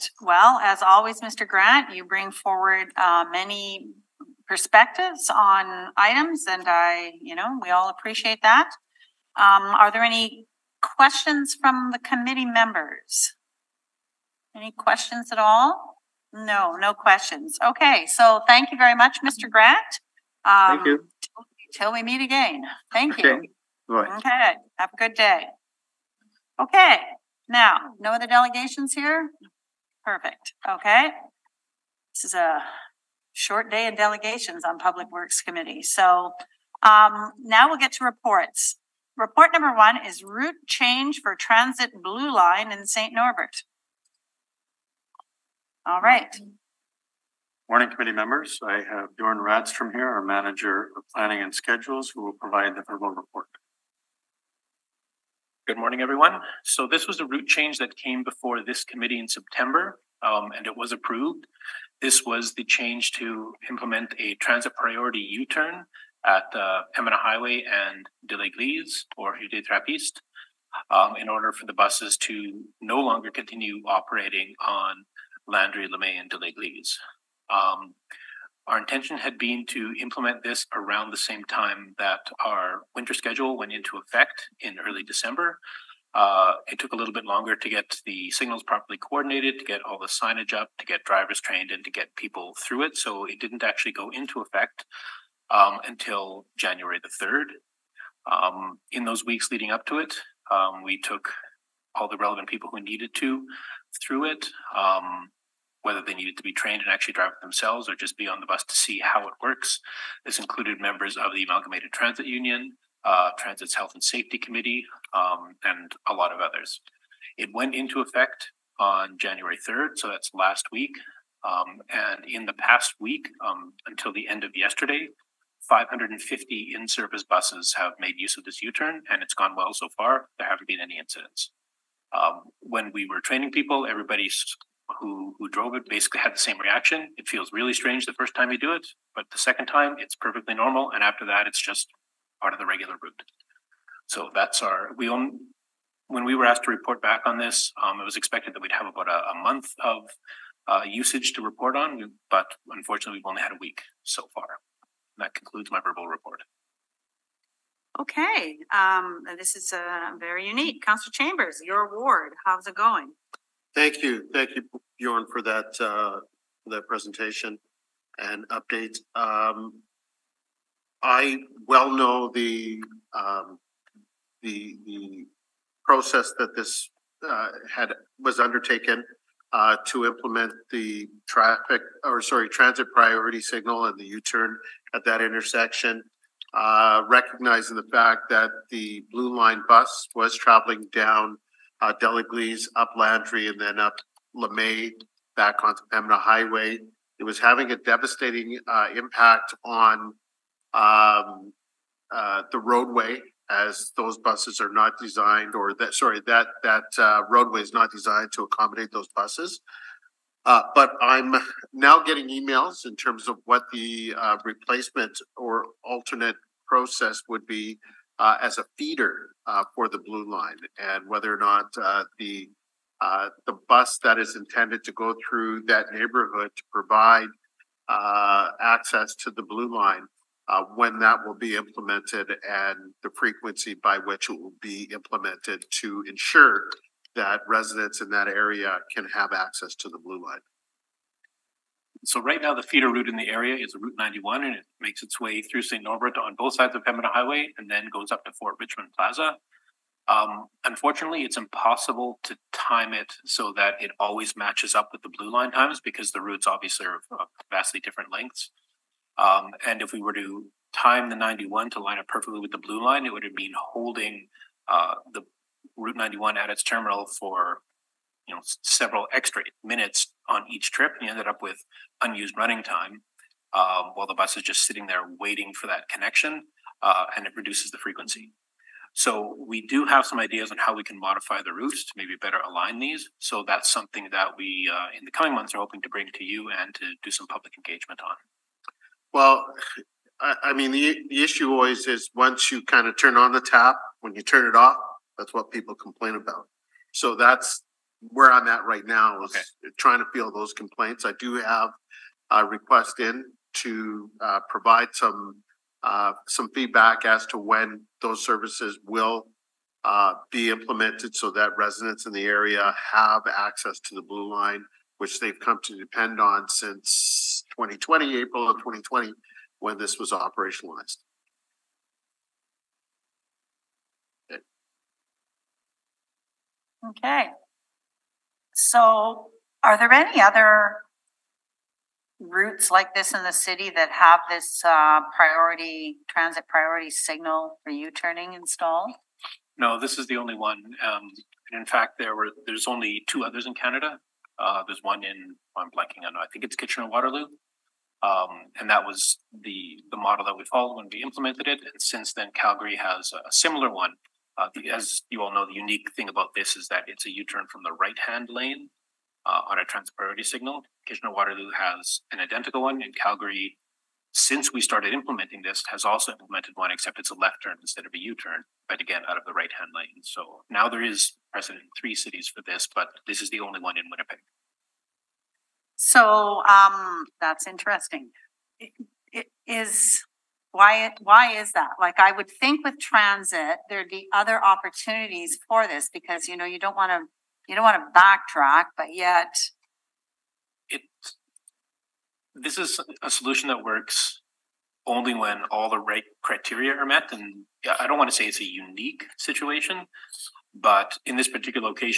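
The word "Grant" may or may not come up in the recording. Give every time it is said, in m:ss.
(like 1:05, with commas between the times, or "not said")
0:01, 0:19.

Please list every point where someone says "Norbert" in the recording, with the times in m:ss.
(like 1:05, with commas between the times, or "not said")
0:43, 4:05.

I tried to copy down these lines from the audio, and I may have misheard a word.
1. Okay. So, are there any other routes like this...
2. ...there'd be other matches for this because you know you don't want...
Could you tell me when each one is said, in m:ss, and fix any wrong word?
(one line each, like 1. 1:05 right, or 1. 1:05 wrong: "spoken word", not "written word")
1. 5:26 right
2. 6:23 wrong: "opportunities", not "matches".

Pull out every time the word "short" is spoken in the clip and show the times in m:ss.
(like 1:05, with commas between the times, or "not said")
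0:33.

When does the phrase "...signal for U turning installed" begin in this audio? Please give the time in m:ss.
5:36.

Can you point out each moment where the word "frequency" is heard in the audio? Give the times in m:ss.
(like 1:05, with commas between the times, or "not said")
3:53, 4:37.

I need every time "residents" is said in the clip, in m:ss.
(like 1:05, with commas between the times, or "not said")
3:57, 5:11.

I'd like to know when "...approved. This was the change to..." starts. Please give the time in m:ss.
1:00.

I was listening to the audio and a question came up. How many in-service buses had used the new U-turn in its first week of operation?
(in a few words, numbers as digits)
550.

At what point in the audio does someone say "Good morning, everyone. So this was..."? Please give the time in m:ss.
0:55.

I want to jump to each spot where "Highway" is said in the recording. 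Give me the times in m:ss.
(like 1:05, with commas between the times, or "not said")
1:07, 3:16, 4:07.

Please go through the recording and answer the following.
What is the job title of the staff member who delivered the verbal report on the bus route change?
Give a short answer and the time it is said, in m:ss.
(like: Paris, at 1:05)
Manager of planning and schedules, at 0:50.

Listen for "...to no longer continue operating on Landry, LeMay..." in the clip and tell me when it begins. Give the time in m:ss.
1:12.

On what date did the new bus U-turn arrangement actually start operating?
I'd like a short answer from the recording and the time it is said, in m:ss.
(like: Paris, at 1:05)
January 3, at 1:36.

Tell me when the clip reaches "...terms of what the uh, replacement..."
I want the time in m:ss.
3:32.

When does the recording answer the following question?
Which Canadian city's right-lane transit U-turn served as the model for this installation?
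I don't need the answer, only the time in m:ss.
5:46.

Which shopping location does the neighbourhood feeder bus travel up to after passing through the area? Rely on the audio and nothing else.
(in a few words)
Fort Richmond Plaza.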